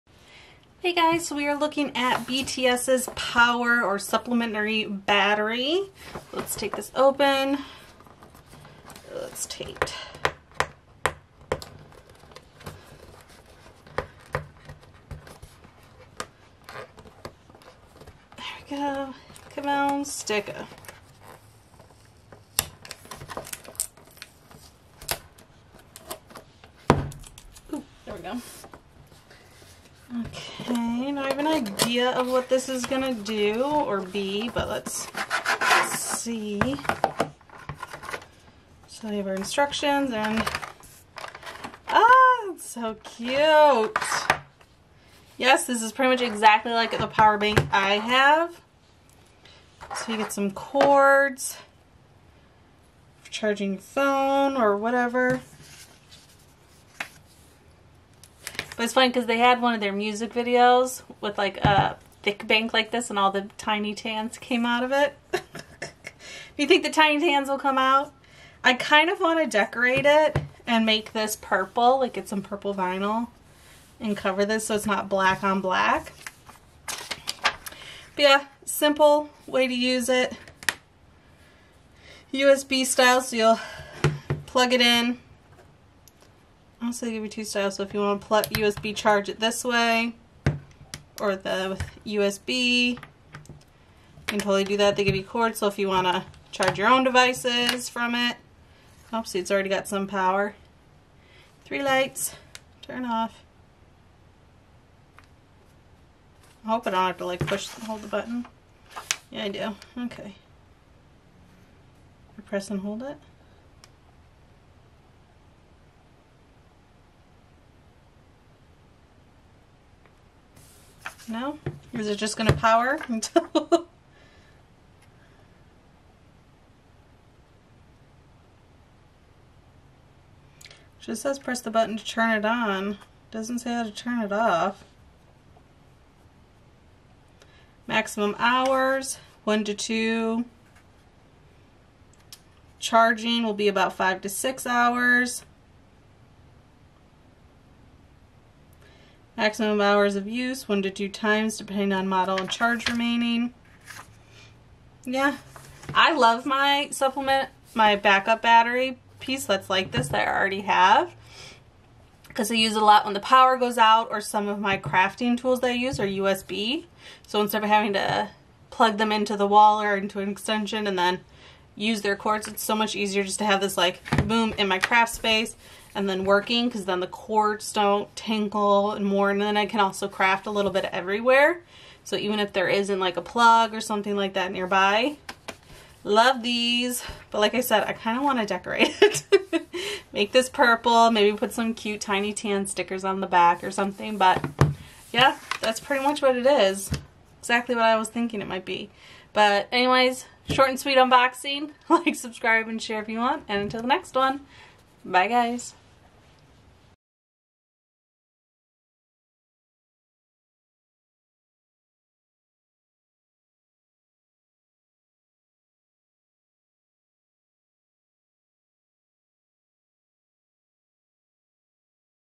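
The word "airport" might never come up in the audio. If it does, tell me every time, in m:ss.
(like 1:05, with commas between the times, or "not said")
not said.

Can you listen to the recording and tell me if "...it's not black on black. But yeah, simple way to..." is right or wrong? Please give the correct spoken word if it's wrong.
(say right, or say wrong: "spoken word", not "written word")
right.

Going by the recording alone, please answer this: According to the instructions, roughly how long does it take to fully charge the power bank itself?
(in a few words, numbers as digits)
5 to 6 hours.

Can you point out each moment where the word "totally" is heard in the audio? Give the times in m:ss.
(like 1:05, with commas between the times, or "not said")
1:34.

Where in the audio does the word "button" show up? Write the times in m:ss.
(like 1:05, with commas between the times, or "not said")
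1:48, 2:11.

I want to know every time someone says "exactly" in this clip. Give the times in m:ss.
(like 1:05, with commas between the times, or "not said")
0:46, 3:17.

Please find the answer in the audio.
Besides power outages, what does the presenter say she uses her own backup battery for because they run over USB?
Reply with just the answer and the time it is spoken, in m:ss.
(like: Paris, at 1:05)
Crafting tools, at 2:44.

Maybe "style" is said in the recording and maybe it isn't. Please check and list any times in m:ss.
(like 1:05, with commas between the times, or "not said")
1:22, 1:27.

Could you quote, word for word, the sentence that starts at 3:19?
But anyways, short and sweet unboxing.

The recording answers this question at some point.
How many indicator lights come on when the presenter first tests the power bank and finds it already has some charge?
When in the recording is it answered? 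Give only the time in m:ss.
1:41.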